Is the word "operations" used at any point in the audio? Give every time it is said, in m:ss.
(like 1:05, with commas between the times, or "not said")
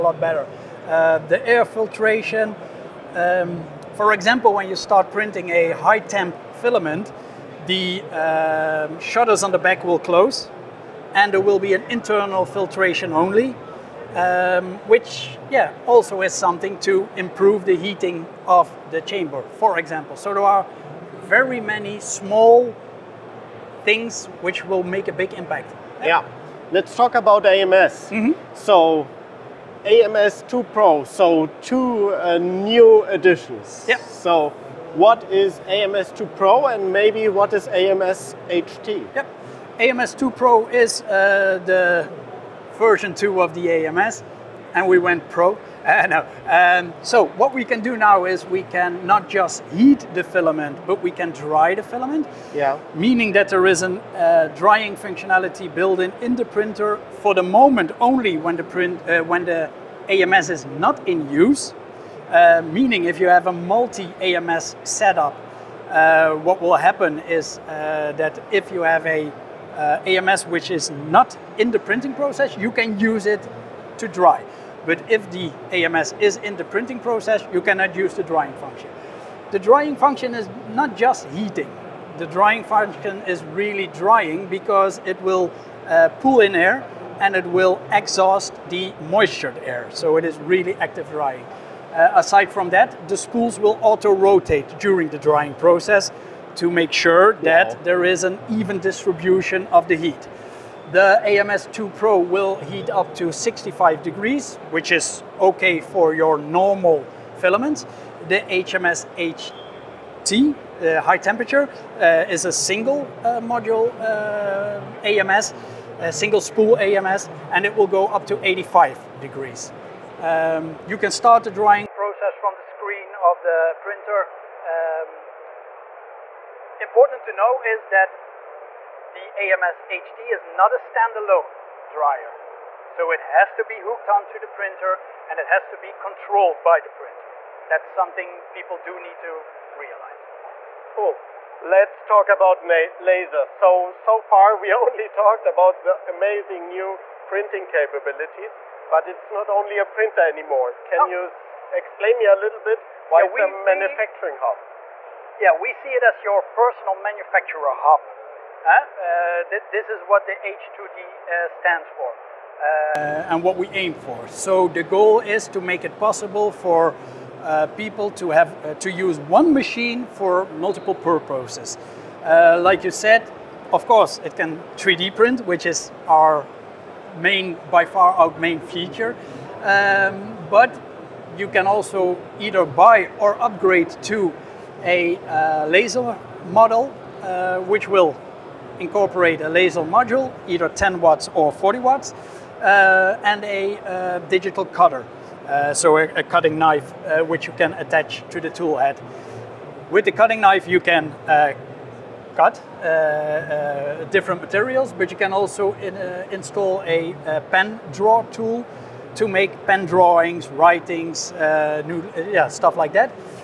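not said.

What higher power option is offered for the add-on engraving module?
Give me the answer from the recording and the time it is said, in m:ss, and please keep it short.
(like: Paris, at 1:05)
40 watts, at 3:11.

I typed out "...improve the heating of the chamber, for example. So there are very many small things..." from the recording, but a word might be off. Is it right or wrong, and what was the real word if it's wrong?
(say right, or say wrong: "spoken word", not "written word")
right.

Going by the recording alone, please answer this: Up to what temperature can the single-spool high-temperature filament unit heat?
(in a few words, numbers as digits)
85 degrees.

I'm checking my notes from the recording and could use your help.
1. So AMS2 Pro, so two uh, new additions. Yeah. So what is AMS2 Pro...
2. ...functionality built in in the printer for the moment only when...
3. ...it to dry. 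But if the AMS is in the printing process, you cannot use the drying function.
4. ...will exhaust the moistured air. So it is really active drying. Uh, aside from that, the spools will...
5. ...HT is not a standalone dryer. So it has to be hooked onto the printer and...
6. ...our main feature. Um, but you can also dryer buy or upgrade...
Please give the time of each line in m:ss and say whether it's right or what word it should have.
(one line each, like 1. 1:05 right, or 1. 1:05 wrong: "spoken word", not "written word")
1. 0:28 right
2. 0:54 right
3. 1:13 right
4. 1:27 right
5. 2:09 right
6. 2:58 wrong: "either", not "dryer".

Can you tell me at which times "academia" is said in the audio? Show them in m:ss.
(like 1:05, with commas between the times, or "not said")
not said.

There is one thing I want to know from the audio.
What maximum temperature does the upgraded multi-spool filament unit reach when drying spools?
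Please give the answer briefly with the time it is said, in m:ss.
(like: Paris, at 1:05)
65 degrees, at 1:43.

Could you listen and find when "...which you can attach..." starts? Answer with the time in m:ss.
3:17.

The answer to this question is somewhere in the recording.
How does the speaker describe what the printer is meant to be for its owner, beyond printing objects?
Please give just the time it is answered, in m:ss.
2:36.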